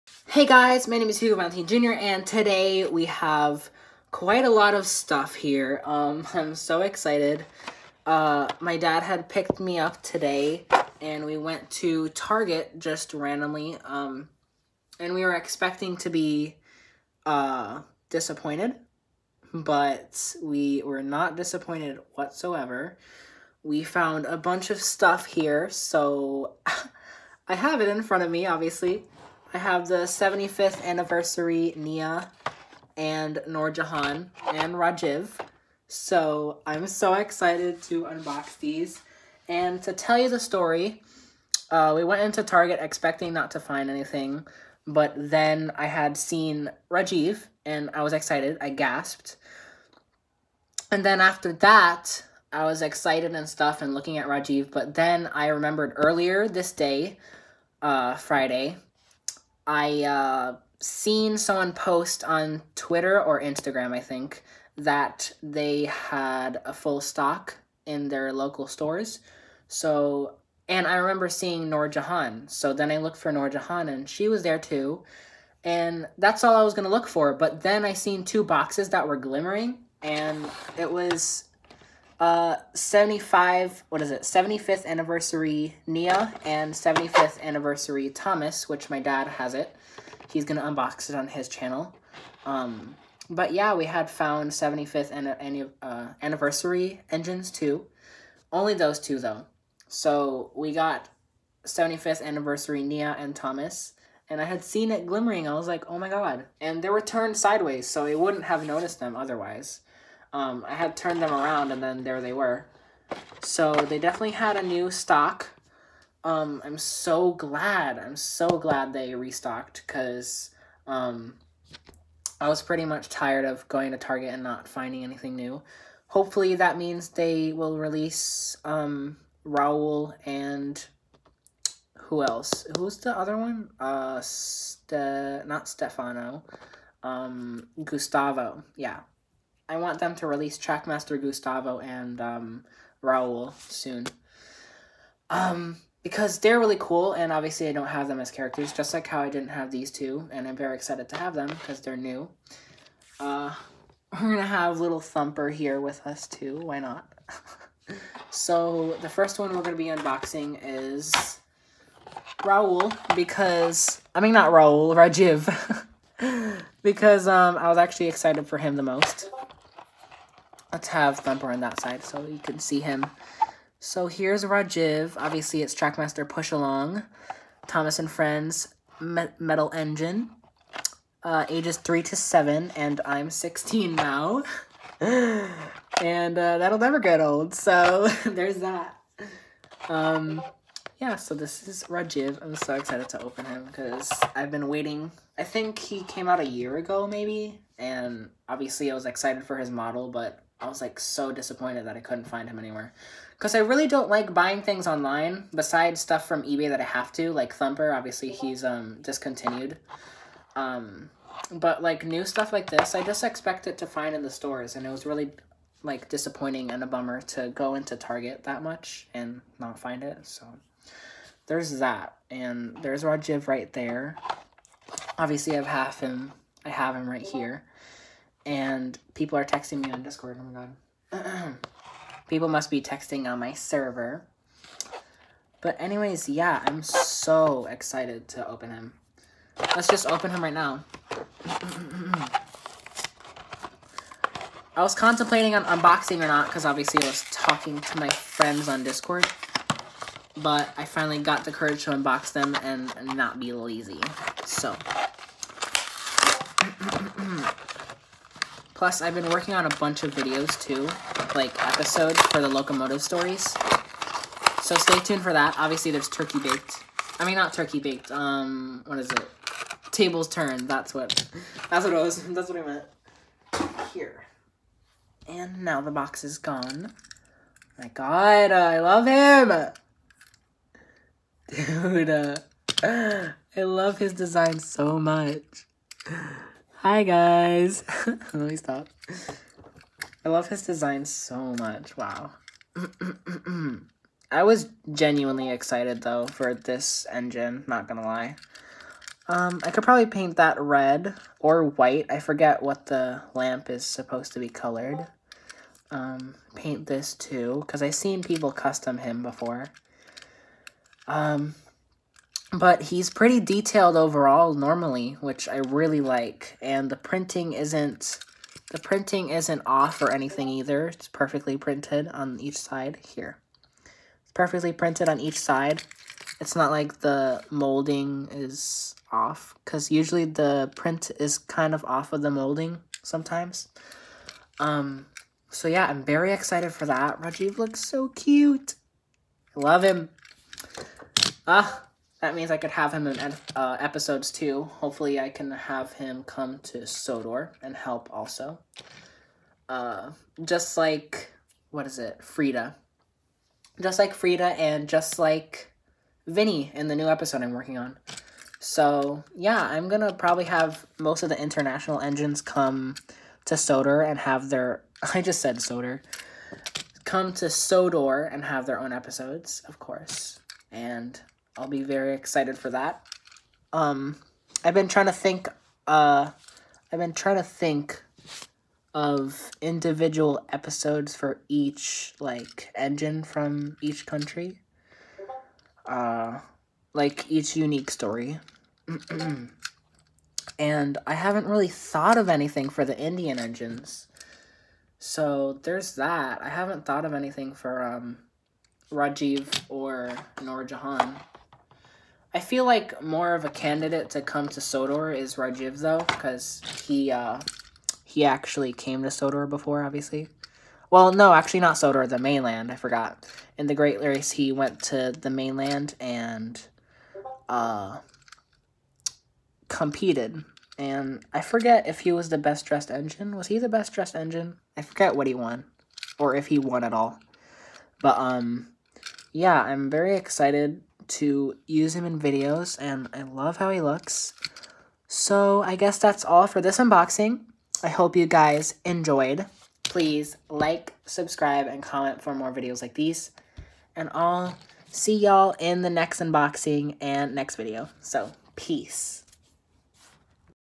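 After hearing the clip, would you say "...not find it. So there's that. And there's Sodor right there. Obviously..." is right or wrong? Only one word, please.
wrong.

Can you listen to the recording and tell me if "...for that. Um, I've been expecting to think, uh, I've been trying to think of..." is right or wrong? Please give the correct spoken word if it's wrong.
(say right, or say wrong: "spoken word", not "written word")
wrong: "trying", not "expecting".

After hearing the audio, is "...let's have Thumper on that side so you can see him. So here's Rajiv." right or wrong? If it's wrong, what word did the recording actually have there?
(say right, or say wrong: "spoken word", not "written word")
right.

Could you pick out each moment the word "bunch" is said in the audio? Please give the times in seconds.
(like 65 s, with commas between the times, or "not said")
24 s, 259 s.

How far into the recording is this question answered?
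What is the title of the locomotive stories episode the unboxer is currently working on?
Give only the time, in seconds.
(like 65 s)
269 s.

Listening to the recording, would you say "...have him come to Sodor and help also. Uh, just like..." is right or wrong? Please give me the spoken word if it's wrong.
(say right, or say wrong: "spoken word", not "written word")
right.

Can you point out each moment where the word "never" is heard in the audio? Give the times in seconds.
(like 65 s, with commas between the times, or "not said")
186 s.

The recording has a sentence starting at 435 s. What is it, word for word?
So I guess that's all for this unboxing.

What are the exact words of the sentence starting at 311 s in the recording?
Um, but he's pretty detailed overall normally, which I really like.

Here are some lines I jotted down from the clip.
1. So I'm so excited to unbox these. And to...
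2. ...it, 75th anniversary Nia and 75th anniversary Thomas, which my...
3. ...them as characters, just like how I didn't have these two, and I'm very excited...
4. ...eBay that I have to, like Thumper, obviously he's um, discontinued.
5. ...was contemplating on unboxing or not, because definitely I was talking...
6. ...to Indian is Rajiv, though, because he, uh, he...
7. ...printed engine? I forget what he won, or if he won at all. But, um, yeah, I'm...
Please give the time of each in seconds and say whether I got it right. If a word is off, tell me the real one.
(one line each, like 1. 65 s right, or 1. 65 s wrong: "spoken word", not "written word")
1. 35 s right
2. 84 s right
3. 148 s right
4. 206 s right
5. 244 s wrong: "obviously", not "definitely"
6. 404 s wrong: "Sodor", not "Indian"
7. 423 s wrong: "dressed", not "printed".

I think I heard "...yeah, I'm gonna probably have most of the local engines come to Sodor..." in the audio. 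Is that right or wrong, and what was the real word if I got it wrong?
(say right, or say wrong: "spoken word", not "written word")
wrong: "international", not "local".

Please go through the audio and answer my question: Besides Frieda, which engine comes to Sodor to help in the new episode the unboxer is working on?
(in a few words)
Vinnie.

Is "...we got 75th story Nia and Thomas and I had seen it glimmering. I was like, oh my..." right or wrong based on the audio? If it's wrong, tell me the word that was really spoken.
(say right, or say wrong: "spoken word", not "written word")
wrong: "anniversary", not "story".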